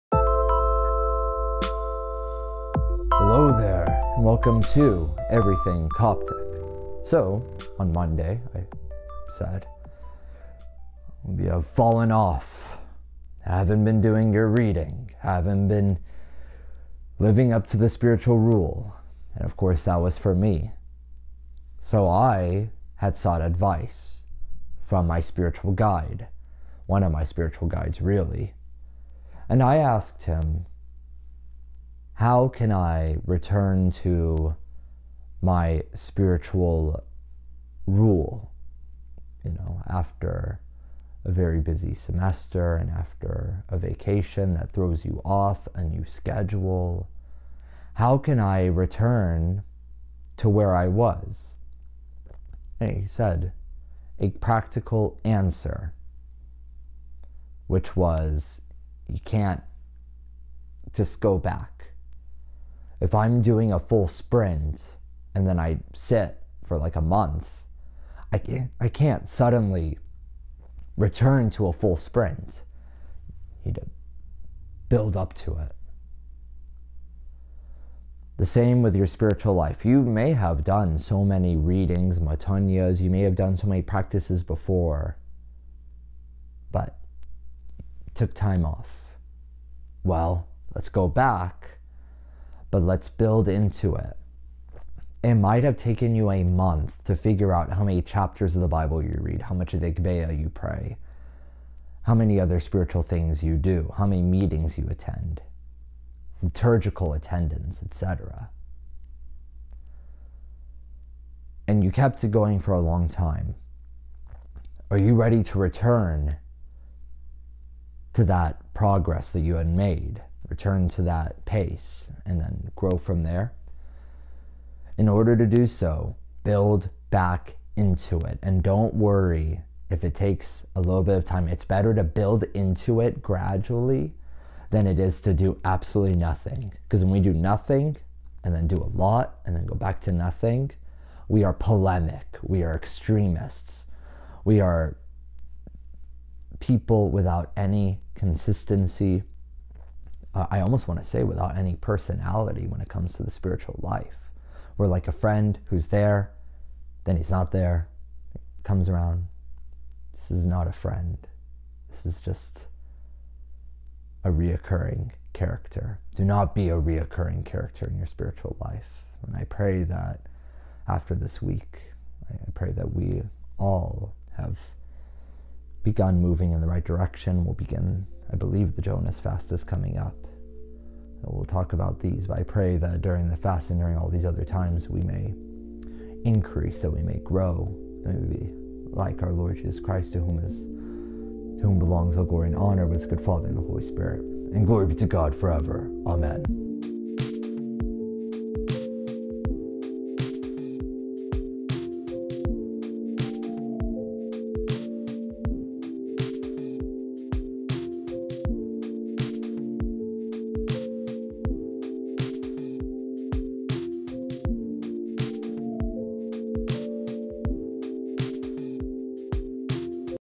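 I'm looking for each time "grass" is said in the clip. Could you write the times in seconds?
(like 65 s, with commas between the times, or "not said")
not said.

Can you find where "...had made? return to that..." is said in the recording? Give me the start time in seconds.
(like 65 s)
119 s.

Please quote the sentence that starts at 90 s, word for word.
Well, let's go back but let's build into it.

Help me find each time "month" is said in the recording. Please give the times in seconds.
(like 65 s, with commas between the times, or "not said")
67 s, 96 s.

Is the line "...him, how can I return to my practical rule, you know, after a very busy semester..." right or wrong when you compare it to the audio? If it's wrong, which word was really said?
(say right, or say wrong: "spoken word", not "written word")
wrong: "spiritual", not "practical".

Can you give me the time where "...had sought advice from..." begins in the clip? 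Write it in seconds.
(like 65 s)
22 s.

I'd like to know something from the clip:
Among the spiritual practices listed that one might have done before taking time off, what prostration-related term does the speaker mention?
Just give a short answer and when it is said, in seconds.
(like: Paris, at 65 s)
metanias, at 82 s.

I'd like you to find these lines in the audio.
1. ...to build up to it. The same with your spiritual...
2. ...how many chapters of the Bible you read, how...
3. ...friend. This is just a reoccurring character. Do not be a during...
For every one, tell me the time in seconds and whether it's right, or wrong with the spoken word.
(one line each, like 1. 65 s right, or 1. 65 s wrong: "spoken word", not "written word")
1. 73 s right
2. 97 s right
3. 160 s wrong: "reoccurring", not "during".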